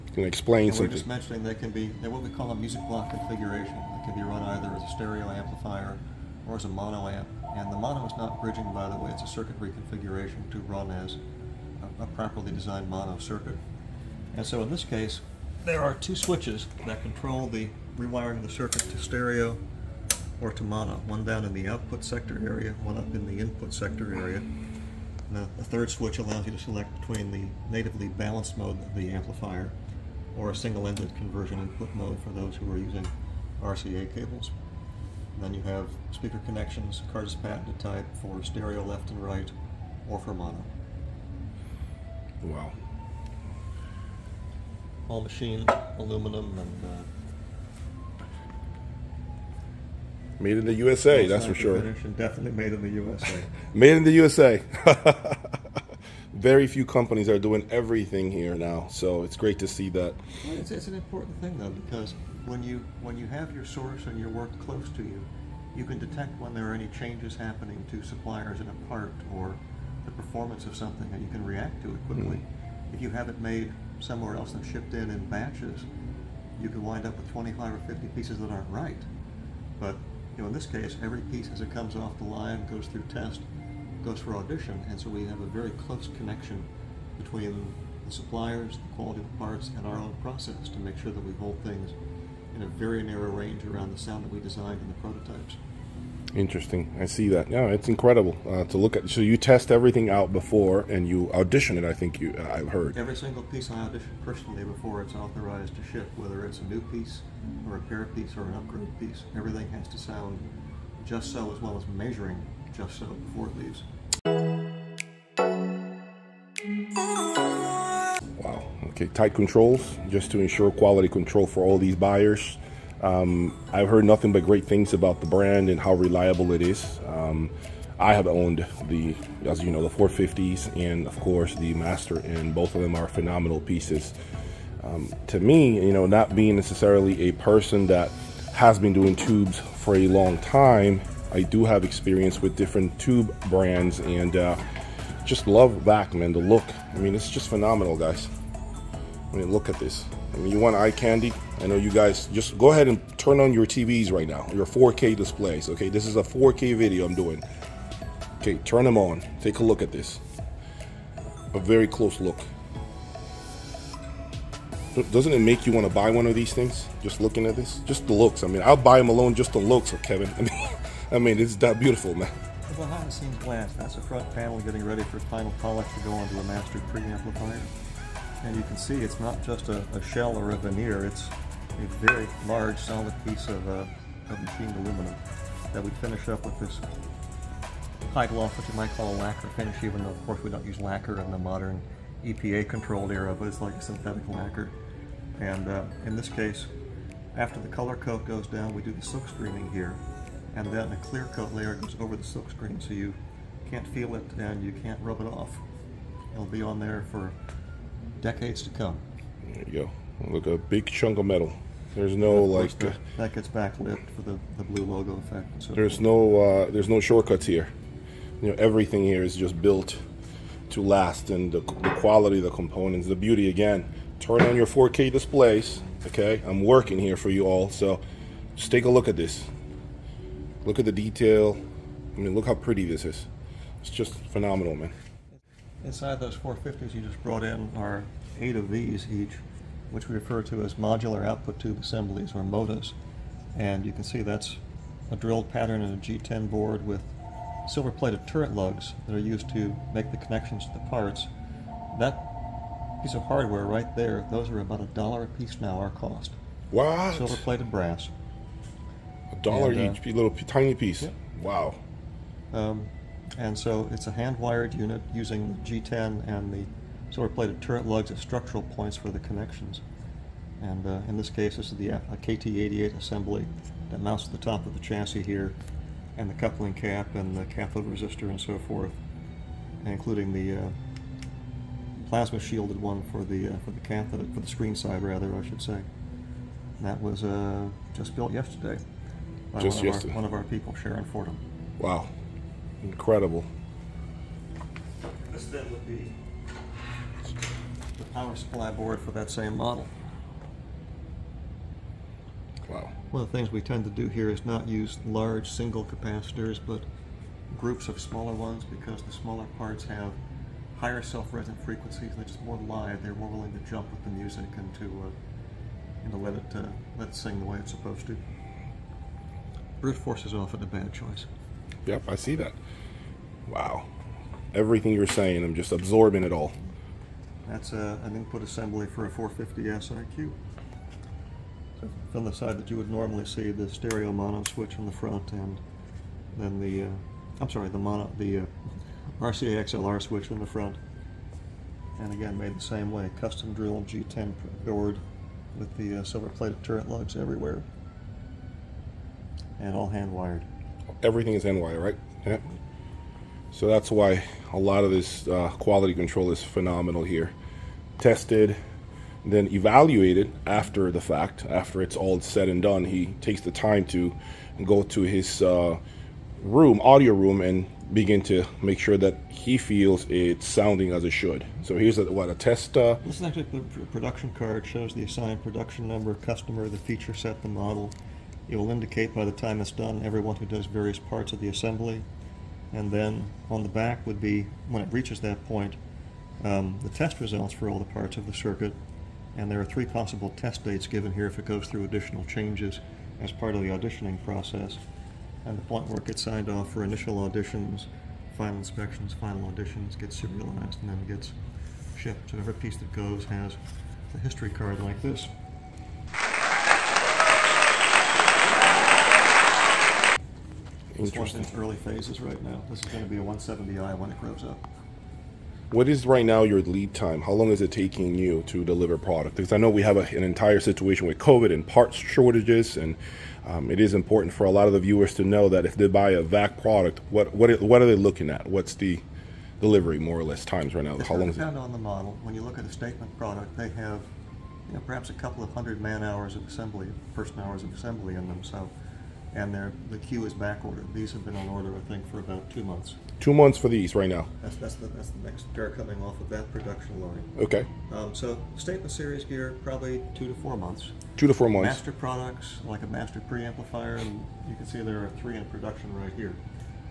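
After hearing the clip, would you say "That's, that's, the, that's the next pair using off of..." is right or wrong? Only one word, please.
wrong.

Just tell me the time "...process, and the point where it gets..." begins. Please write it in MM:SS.
06:34.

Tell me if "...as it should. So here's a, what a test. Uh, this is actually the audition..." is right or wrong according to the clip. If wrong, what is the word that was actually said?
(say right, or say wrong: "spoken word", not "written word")
wrong: "production", not "audition".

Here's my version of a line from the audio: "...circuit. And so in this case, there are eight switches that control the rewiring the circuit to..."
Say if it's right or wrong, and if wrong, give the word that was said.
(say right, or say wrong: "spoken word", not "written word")
wrong: "two", not "eight".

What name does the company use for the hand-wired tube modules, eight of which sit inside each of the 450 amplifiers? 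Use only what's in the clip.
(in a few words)
MOTAs.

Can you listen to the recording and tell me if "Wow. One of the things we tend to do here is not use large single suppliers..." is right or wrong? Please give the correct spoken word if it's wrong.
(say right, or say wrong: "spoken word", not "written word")
wrong: "capacitors", not "suppliers".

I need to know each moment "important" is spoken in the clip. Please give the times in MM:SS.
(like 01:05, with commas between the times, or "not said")
01:00, 07:03.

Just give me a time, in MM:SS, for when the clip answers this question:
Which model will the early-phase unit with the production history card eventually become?
06:53.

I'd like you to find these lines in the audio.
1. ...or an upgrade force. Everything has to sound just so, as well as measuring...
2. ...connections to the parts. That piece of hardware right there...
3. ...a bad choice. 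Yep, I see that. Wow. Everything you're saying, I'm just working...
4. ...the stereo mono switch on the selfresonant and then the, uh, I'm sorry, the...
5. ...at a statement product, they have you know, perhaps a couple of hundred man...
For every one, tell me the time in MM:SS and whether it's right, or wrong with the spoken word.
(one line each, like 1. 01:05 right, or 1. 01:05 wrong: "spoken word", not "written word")
1. 01:48 wrong: "piece", not "force"
2. 04:10 right
3. 05:20 wrong: "absorbing", not "working"
4. 05:33 wrong: "front", not "selfresonant"
5. 07:12 right.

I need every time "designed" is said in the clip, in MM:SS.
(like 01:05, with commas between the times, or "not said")
00:12, 01:34.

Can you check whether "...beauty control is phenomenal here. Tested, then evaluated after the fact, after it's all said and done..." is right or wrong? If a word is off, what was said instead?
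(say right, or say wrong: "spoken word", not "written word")
wrong: "quality", not "beauty".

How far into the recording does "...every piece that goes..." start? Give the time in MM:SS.
06:42.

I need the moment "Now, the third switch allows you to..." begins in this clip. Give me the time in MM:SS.
00:25.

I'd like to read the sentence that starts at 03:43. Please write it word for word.
Again, turn on your 4K displays.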